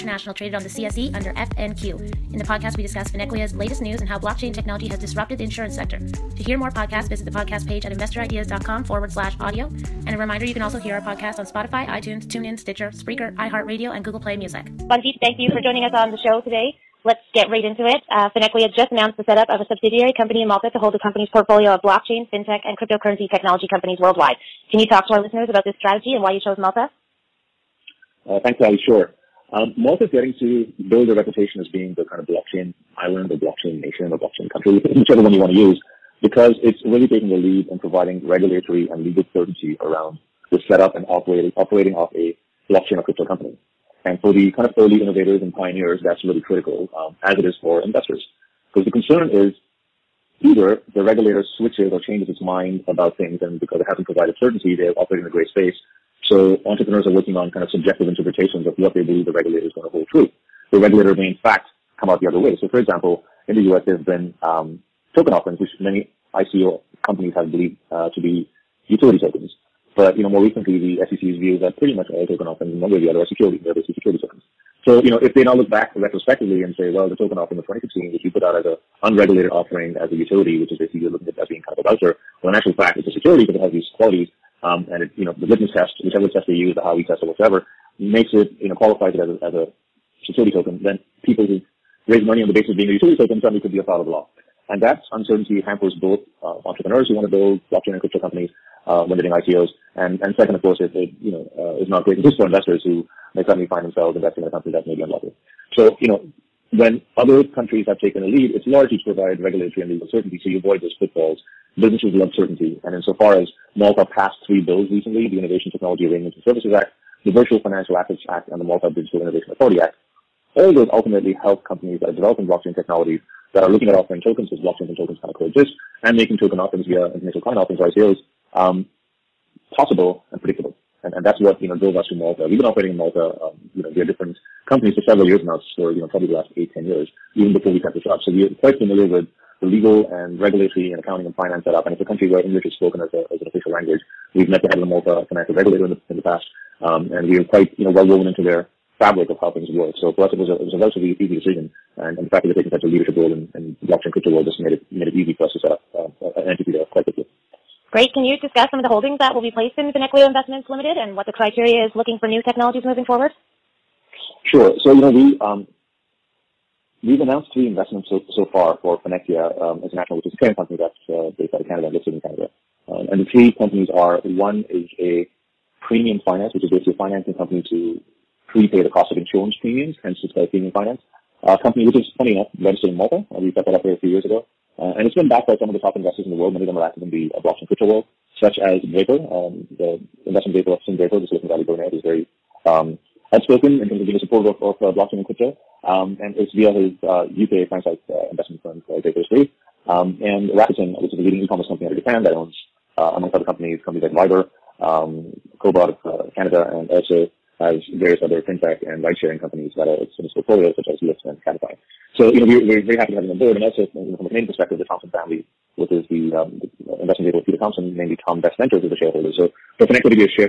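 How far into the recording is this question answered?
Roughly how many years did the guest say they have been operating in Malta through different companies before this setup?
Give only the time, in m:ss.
2:16.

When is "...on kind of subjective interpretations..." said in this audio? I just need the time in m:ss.
0:57.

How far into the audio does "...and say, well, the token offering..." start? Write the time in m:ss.
1:16.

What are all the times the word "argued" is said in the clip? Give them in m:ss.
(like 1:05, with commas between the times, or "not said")
not said.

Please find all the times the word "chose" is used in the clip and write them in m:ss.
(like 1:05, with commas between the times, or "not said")
0:26.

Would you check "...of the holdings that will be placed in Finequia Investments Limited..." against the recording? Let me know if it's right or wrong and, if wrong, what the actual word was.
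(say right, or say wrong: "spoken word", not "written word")
right.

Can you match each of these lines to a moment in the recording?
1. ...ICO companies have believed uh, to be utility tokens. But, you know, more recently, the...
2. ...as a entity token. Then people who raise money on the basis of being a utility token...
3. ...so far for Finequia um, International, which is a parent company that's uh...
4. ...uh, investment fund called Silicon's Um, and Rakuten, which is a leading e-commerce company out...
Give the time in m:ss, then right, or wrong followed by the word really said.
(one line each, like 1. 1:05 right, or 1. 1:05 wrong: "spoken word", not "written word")
1. 1:06 right
2. 1:29 wrong: "security", not "entity"
3. 2:48 right
4. 3:18 wrong: "Draper", not "Silicon".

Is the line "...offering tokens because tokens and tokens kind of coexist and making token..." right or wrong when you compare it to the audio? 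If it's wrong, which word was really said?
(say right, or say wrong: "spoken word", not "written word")
wrong: "blockchains", not "tokens".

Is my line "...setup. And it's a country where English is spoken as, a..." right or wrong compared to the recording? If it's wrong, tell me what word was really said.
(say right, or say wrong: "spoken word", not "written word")
right.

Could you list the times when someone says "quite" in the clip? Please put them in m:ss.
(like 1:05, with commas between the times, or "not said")
2:18, 2:27, 2:36.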